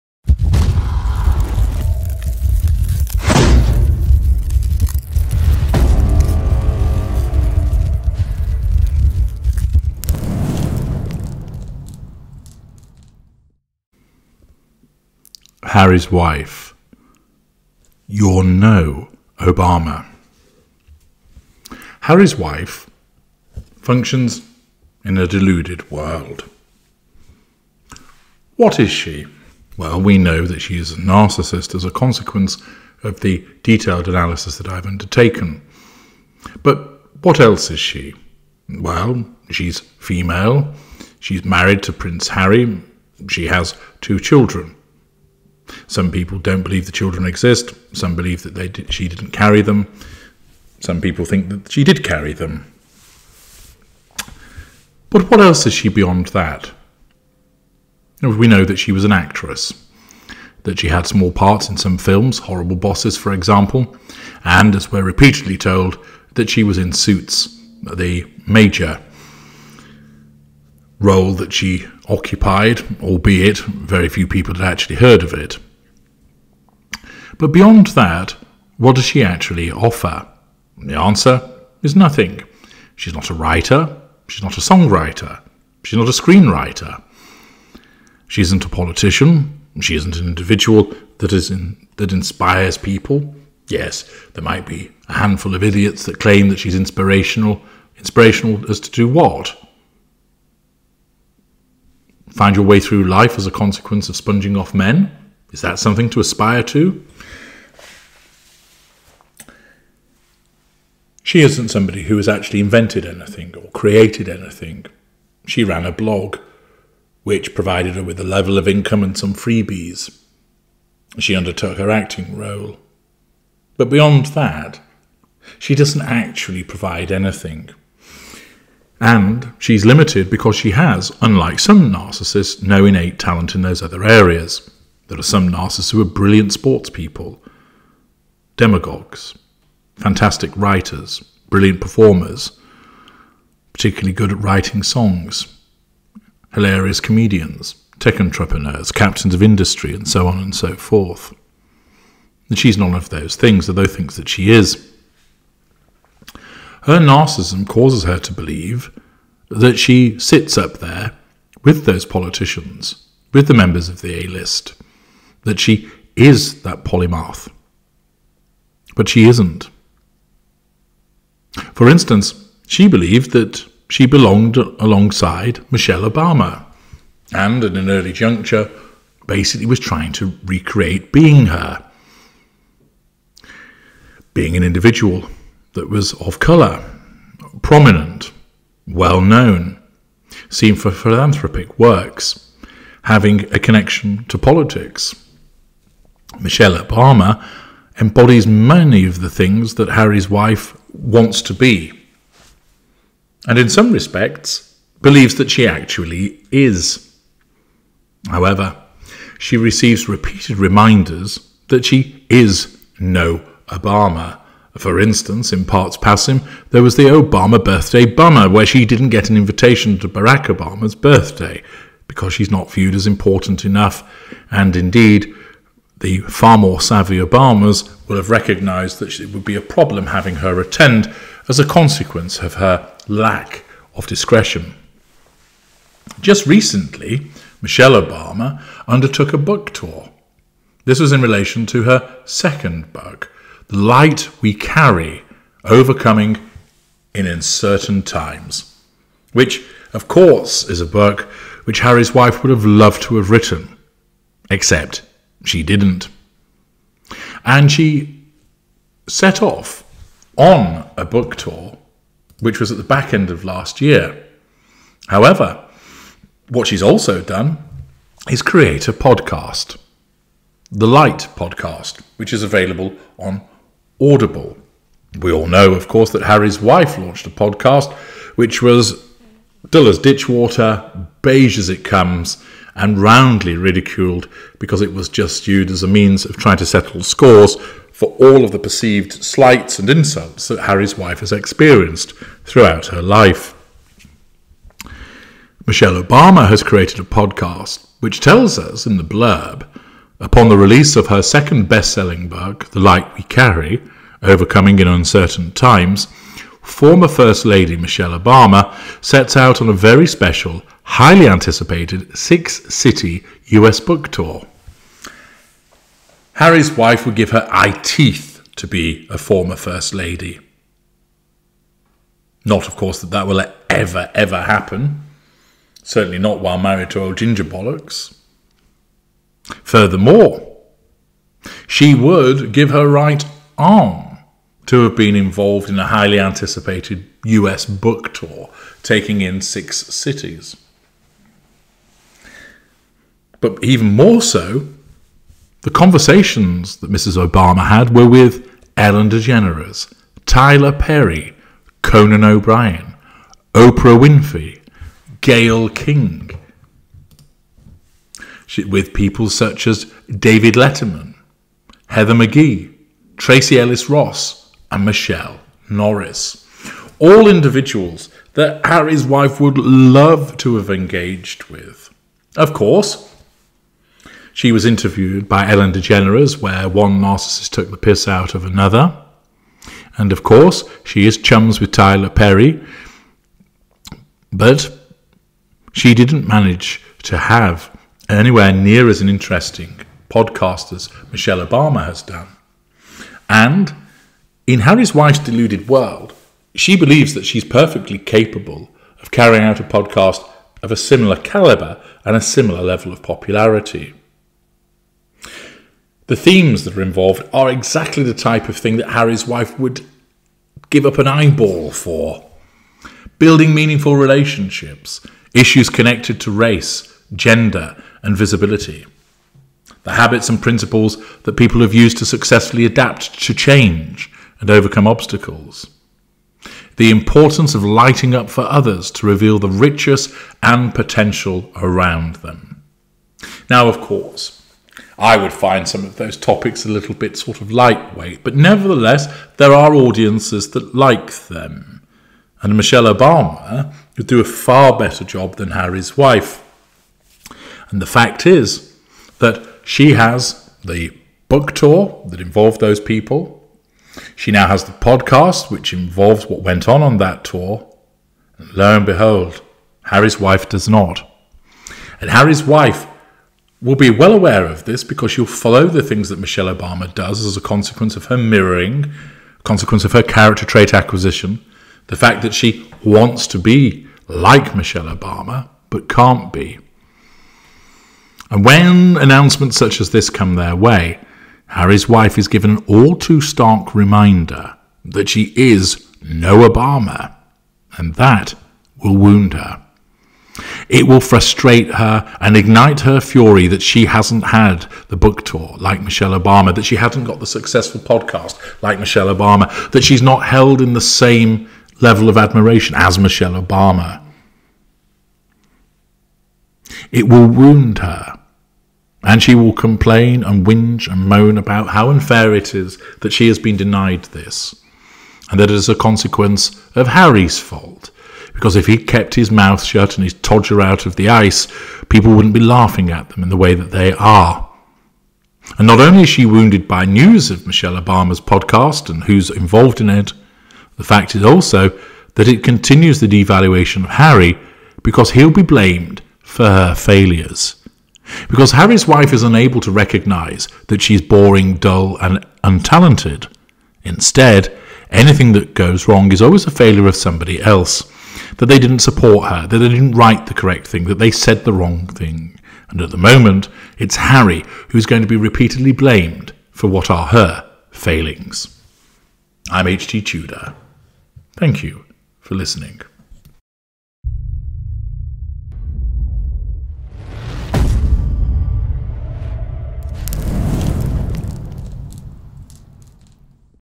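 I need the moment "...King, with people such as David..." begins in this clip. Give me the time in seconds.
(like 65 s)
355 s.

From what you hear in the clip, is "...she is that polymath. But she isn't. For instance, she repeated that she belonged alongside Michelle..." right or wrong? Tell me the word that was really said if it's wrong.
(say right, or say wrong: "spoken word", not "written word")
wrong: "believed", not "repeated".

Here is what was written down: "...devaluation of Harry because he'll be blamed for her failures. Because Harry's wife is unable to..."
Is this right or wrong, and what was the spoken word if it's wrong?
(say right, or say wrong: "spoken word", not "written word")
right.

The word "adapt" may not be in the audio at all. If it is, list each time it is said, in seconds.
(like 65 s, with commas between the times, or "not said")
422 s.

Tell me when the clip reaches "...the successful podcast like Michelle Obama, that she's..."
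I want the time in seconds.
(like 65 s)
497 s.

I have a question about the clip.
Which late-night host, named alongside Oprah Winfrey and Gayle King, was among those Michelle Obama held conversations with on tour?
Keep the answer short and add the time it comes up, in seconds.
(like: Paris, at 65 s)
Conan O'Brien, at 351 s.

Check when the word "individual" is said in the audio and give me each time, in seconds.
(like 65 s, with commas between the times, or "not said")
90 s, 184 s, 367 s.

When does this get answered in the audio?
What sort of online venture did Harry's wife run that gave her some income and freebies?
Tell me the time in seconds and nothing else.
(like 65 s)
115 s.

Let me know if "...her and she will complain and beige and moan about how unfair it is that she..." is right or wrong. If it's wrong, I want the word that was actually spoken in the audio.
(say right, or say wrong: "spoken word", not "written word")
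wrong: "whinge", not "beige".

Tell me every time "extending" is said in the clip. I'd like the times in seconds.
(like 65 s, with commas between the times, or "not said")
not said.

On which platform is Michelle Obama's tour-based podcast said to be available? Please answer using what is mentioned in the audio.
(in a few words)
Audible.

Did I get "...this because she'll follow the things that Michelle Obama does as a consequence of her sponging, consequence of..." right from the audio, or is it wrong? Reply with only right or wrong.
wrong.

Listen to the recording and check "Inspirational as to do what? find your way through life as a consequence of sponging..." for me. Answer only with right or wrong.
right.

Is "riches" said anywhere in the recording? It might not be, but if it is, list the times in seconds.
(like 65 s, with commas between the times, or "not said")
429 s.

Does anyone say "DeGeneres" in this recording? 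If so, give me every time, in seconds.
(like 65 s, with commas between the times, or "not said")
349 s, 375 s.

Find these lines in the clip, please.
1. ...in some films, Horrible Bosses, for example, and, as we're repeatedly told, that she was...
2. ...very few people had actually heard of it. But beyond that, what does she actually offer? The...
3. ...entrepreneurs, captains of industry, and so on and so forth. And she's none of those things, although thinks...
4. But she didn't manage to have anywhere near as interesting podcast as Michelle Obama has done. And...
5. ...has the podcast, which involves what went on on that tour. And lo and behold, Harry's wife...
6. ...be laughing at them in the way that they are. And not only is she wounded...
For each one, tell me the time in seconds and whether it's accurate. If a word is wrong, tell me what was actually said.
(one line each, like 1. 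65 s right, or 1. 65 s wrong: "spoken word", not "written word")
1. 61 s right
2. 73 s right
3. 148 s right
4. 384 s right
5. 454 s right
6. 522 s right.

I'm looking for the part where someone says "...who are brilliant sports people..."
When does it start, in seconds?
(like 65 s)
135 s.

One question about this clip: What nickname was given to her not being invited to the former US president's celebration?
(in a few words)
Obama birthday bummer.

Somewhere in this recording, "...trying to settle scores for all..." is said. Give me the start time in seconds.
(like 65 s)
286 s.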